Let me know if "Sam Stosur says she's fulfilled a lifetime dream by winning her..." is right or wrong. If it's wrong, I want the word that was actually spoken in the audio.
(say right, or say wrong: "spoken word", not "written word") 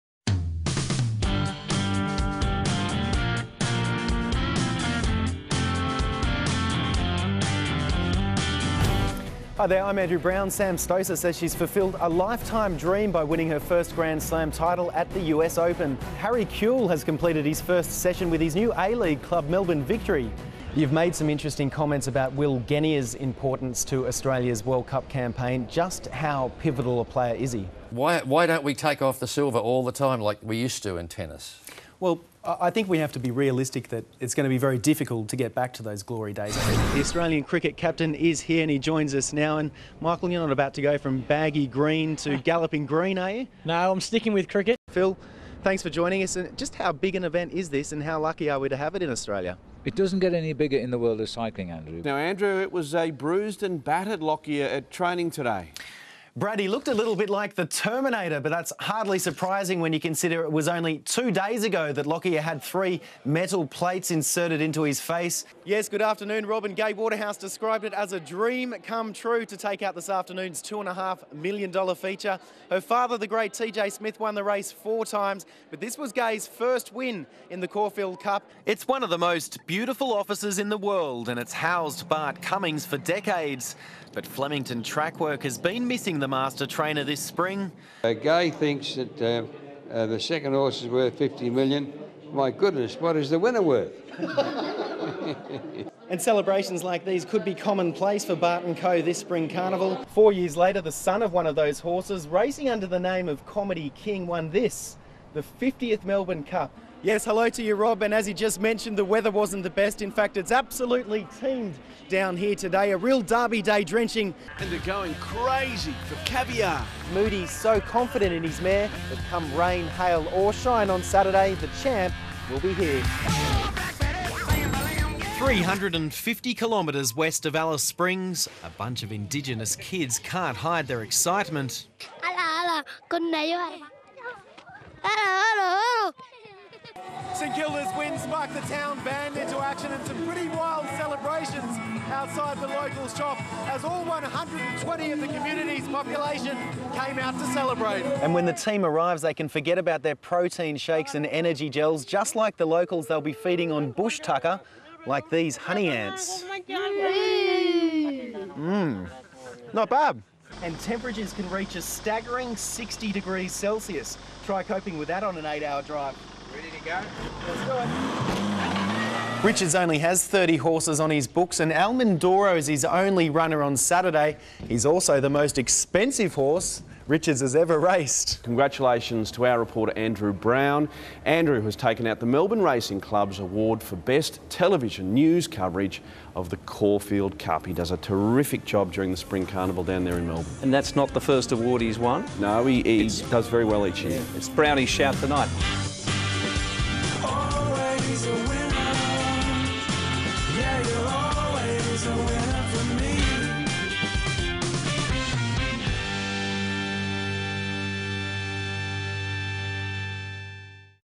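right.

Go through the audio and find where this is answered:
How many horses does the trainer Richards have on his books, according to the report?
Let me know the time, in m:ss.
2:50.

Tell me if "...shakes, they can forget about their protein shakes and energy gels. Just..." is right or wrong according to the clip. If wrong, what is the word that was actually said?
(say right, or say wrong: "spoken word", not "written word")
wrong: "arrives", not "shakes".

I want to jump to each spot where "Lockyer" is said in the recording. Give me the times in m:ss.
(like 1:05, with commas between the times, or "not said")
0:54, 1:02.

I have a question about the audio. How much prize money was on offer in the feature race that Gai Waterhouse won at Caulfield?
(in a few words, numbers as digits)
$2.5 million.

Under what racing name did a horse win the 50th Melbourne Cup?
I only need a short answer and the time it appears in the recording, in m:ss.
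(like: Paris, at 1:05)
Comedy King, at 1:43.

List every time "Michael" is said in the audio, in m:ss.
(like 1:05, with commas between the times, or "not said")
0:39.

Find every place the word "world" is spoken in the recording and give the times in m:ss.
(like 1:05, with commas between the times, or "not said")
0:24, 0:50, 1:20.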